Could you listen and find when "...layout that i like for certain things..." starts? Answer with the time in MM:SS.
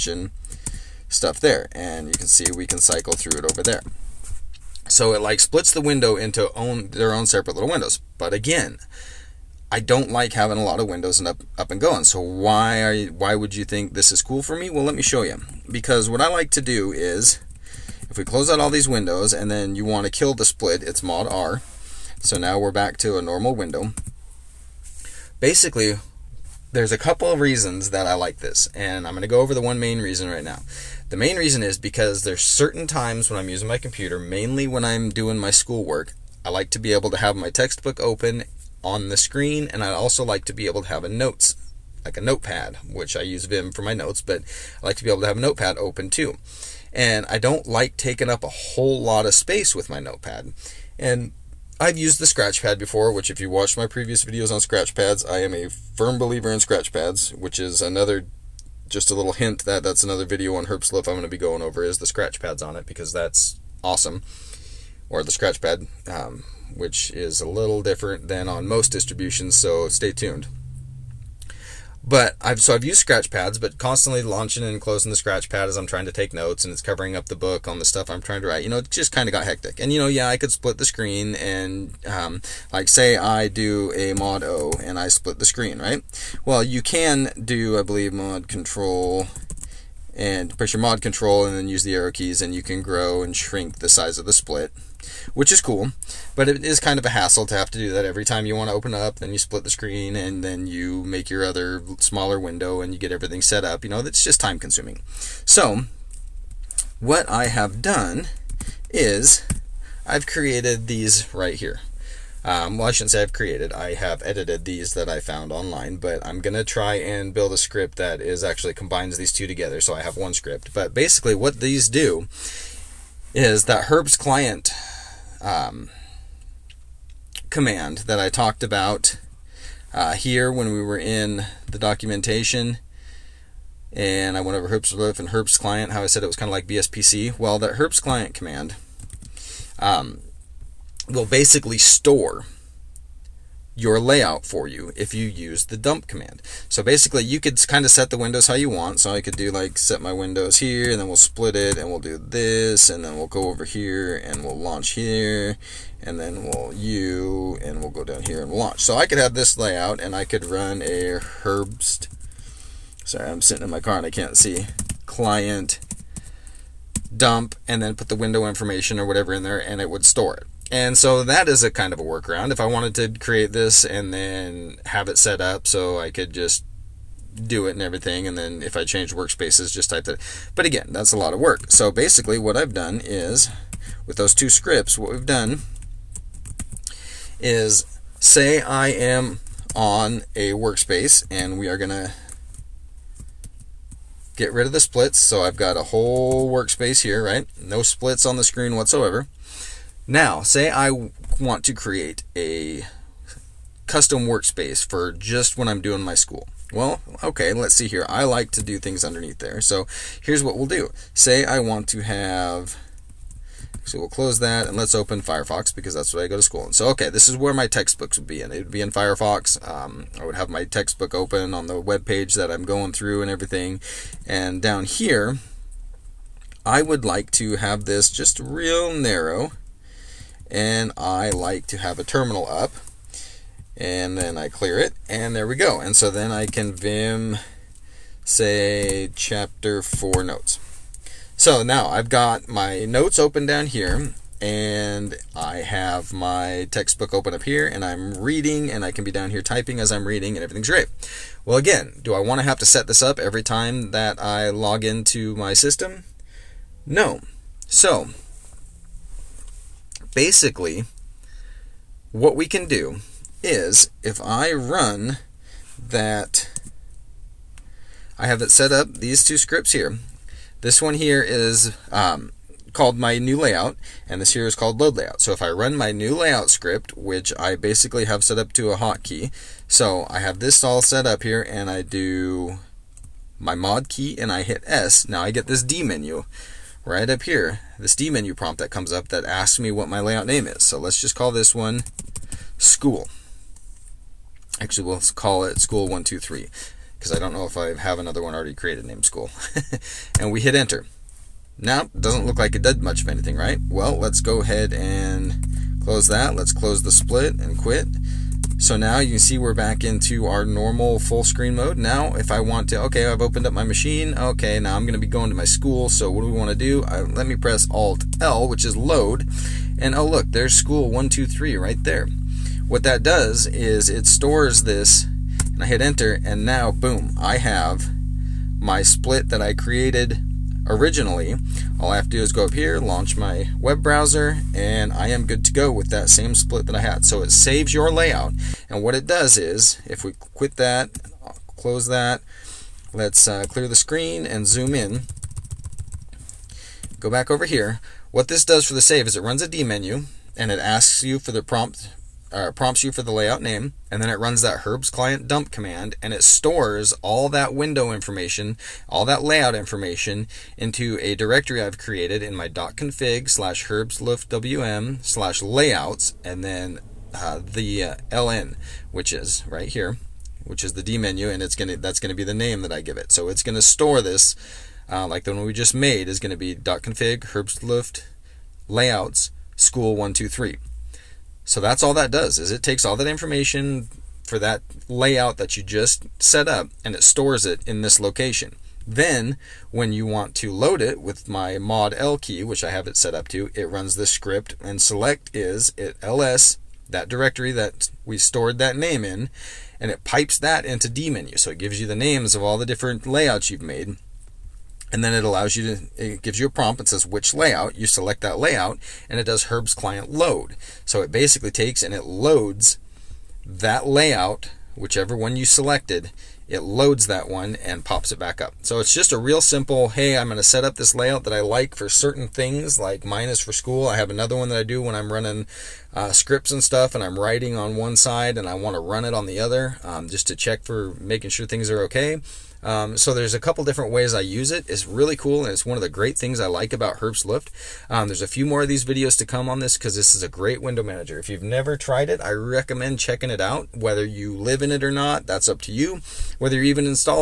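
07:00.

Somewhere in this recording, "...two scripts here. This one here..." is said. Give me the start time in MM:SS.
04:29.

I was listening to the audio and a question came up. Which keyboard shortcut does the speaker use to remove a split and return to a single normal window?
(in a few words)
Mod R.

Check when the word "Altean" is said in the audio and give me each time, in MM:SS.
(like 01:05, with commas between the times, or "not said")
not said.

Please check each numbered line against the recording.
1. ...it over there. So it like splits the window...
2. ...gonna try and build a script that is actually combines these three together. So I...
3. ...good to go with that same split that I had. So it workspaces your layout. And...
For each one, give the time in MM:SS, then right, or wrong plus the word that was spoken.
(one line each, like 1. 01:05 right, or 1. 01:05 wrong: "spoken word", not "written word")
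1. 00:03 right
2. 01:56 wrong: "two", not "three"
3. 05:35 wrong: "saves", not "workspaces".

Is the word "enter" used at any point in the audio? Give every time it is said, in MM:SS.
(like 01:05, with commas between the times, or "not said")
05:00, 05:25.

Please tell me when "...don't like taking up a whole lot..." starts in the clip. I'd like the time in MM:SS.
00:47.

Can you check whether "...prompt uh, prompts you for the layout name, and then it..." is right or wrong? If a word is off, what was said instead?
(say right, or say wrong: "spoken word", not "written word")
right.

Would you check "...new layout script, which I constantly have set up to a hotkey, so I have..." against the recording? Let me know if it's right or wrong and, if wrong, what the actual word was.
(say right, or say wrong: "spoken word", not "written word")
wrong: "basically", not "constantly".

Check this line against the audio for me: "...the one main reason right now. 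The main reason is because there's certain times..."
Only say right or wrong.
right.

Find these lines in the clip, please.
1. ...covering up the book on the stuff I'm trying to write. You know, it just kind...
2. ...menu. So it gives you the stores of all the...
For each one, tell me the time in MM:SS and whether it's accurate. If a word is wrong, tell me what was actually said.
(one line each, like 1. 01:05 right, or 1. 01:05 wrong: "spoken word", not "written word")
1. 01:16 right
2. 06:41 wrong: "names", not "stores".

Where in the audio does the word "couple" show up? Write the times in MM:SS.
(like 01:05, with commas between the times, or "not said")
00:26, 07:13.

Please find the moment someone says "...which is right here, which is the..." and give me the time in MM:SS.
06:08.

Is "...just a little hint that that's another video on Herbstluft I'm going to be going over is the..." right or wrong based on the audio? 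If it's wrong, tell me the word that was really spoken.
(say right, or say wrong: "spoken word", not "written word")
right.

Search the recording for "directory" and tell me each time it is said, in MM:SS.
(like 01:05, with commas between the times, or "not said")
06:01, 06:37.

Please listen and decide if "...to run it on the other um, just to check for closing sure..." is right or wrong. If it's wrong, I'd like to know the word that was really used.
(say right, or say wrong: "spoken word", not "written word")
wrong: "making", not "closing".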